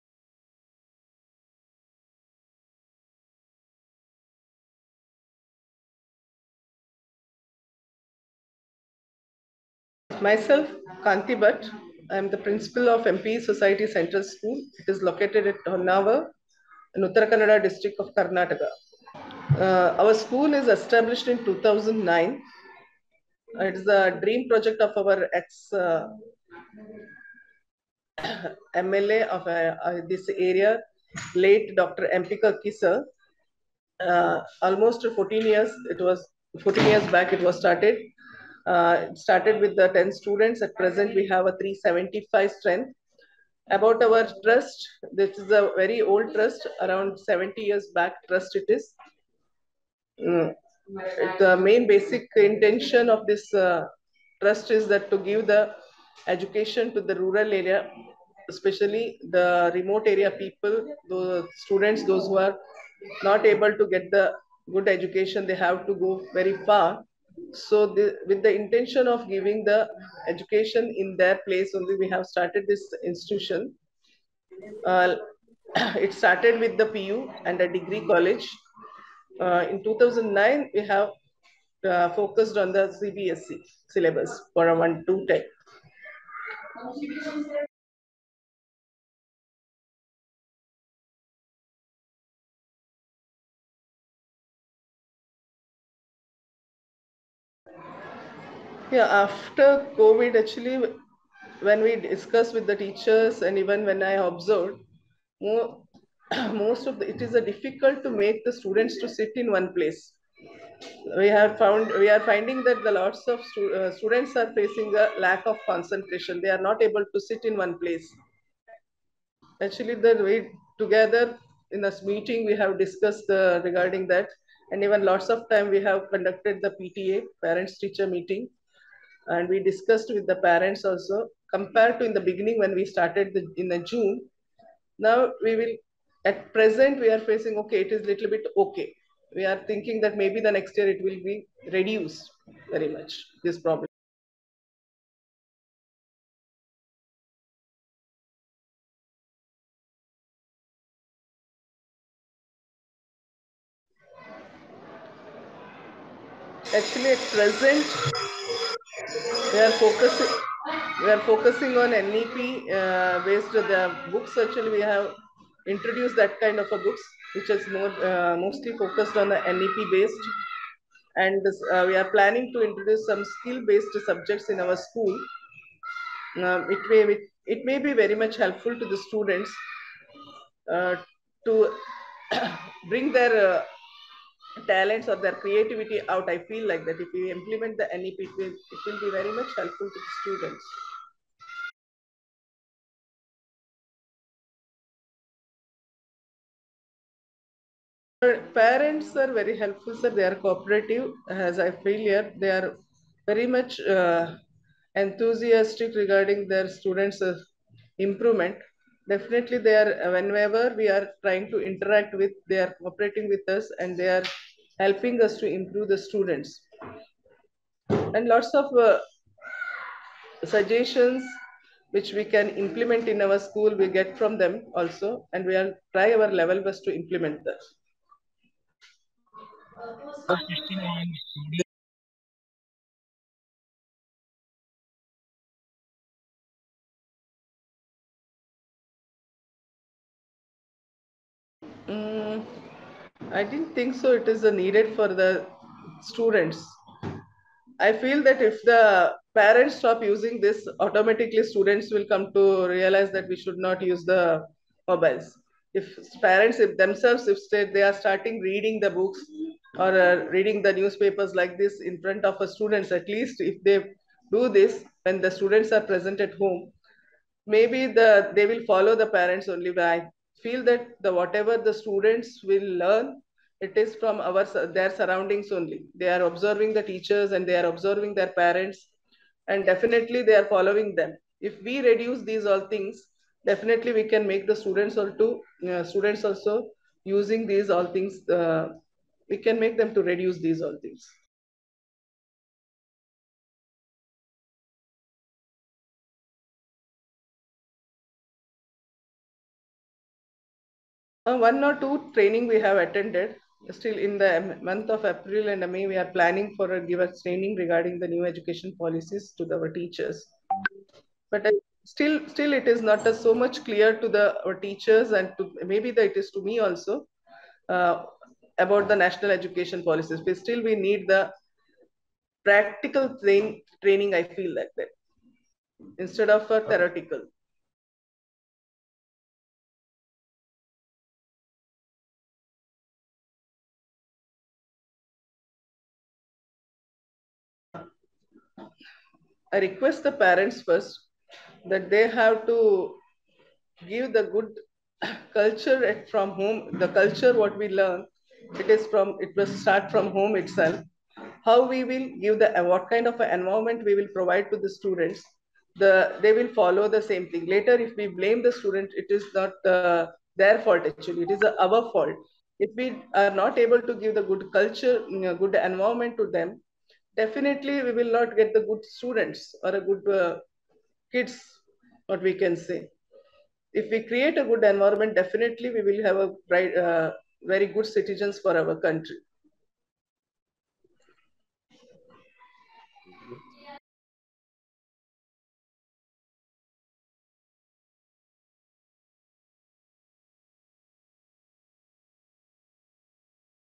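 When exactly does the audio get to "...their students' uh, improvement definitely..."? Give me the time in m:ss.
3:26.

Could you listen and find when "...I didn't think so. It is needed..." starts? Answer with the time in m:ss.
4:03.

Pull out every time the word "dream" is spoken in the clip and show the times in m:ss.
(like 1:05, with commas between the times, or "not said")
0:24.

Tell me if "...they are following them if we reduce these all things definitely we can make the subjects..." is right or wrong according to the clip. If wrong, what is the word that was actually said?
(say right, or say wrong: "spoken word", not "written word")
wrong: "students", not "subjects".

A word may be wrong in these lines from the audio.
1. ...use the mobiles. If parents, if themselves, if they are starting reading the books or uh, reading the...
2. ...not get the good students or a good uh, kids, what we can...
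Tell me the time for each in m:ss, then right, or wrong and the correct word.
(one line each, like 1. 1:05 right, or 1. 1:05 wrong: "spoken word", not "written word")
1. 4:13 right
2. 6:08 right.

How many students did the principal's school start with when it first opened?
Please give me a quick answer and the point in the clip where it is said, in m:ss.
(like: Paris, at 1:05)
10, at 0:39.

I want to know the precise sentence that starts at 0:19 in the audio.
Uh, our school is established in 2009.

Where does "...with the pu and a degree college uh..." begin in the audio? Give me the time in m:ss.
1:16.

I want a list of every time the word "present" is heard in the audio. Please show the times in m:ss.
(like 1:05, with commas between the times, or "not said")
0:40, 2:16, 2:37, 4:25.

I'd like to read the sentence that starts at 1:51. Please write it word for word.
We have found we are finding that the lots of stu uh, students are facing a lack of concentration.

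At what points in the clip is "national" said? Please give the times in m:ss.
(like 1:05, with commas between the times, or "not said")
5:18.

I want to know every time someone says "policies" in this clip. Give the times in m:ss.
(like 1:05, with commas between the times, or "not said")
5:08, 5:19.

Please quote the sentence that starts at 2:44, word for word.
Actually, we have introduced that kind of a books, which is more uh, mostly focused on the NEP based.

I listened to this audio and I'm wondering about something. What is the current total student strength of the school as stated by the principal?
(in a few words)
375.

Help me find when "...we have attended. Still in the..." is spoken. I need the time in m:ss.
5:02.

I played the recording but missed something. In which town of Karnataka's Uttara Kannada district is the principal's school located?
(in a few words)
Honnavar.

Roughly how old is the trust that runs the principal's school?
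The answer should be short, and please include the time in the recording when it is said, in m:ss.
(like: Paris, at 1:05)
70 years, at 0:47.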